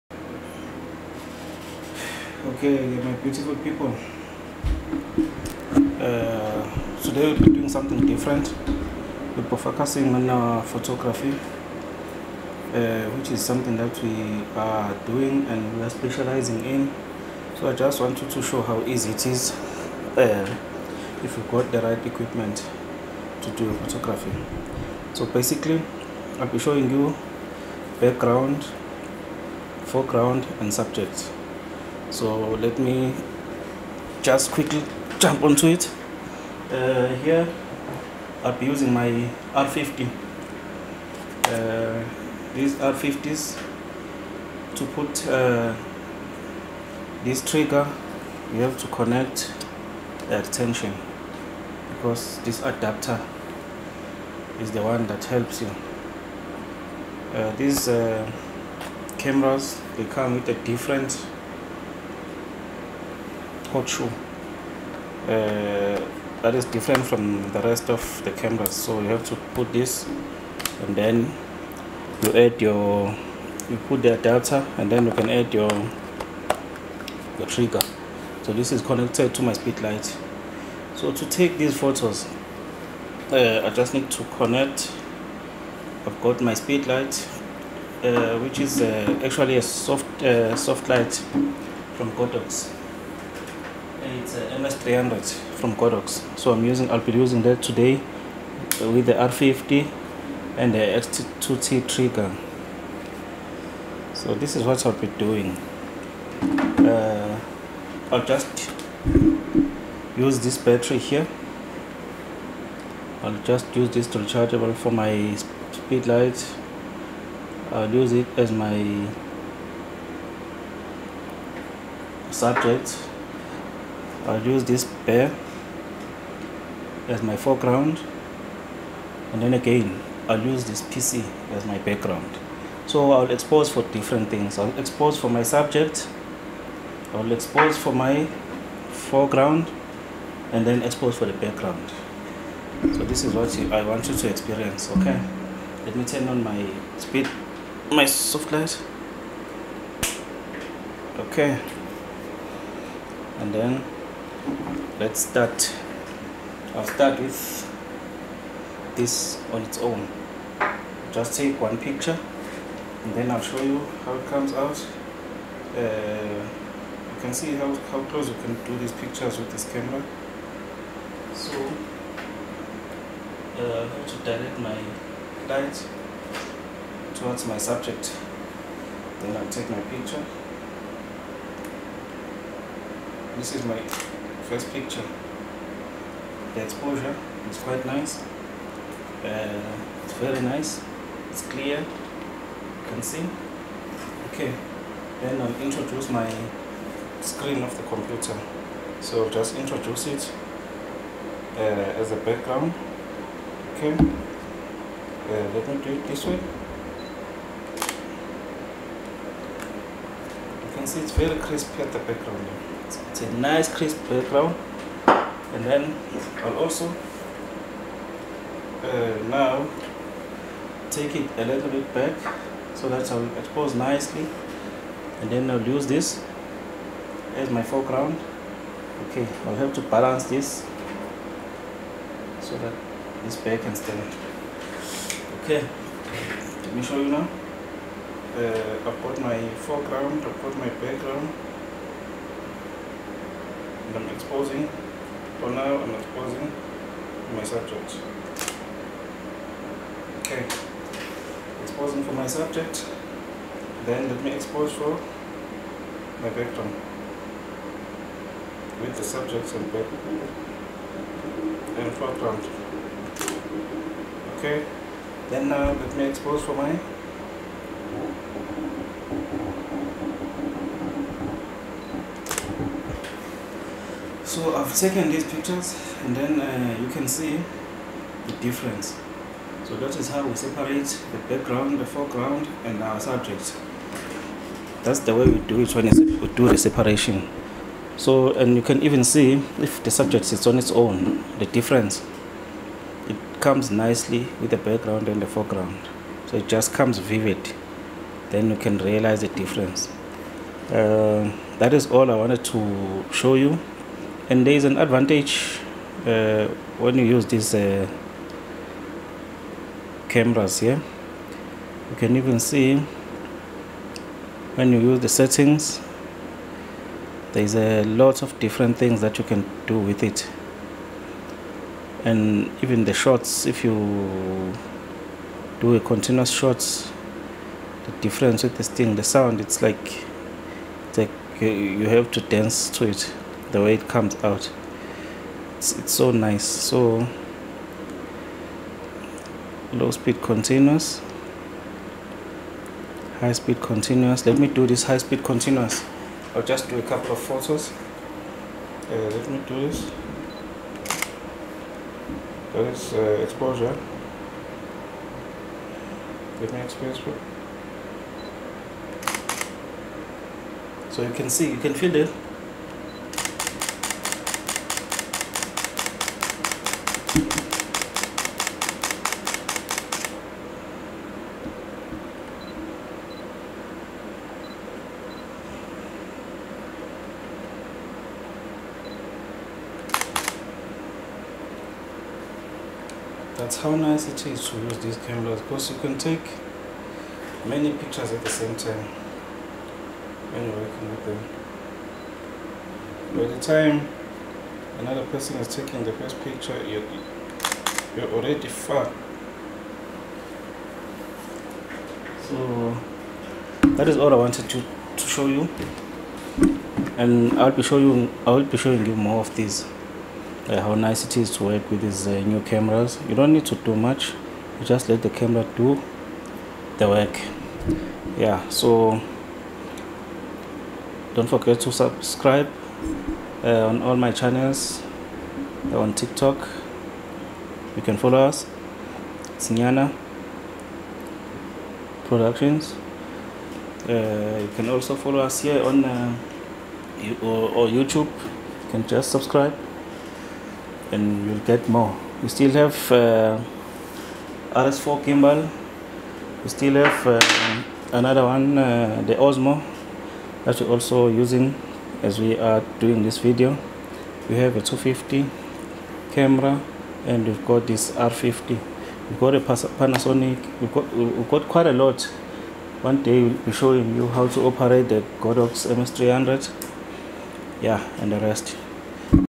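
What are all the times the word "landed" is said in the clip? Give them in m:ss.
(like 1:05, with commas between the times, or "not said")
not said.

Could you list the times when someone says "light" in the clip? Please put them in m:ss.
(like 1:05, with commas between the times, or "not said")
1:19, 1:26, 1:30, 1:56, 2:28, 2:55.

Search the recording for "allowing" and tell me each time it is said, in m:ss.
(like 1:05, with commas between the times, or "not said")
not said.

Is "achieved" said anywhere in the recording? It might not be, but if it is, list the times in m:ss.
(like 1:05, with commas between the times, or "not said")
not said.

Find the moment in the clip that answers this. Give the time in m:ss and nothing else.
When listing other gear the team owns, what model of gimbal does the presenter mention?
7:24.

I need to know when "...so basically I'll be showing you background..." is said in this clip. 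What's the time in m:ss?
0:25.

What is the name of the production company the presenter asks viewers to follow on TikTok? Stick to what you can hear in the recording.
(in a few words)
Sinyana Productions.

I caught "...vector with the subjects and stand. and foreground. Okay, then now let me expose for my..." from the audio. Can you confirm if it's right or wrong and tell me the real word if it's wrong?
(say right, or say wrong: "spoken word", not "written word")
wrong: "background", not "stand".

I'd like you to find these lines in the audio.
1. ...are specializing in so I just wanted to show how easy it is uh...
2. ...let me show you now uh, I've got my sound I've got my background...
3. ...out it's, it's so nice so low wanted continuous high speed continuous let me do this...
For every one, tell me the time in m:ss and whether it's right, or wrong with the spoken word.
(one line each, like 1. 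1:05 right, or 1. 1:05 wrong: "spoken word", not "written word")
1. 0:15 right
2. 3:56 wrong: "foreground", not "sound"
3. 5:34 wrong: "speed", not "wanted".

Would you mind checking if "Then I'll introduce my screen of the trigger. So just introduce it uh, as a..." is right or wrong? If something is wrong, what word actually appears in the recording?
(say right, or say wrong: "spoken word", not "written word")
wrong: "computer", not "trigger".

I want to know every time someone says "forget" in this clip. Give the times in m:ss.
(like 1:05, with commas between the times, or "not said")
7:01.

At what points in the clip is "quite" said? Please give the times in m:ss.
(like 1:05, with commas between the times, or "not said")
3:07, 7:41.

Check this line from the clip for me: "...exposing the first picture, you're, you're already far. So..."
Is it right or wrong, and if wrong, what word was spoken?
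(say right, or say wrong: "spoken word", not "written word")
wrong: "taking", not "exposing".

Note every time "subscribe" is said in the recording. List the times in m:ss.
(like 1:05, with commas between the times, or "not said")
7:01, 7:19.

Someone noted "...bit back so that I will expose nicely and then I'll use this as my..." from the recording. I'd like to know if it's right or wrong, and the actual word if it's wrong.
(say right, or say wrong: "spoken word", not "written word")
right.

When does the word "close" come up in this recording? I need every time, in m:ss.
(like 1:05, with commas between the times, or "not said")
2:48.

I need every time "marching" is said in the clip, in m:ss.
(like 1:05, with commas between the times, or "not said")
not said.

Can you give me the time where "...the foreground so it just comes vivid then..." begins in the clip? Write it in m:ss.
4:55.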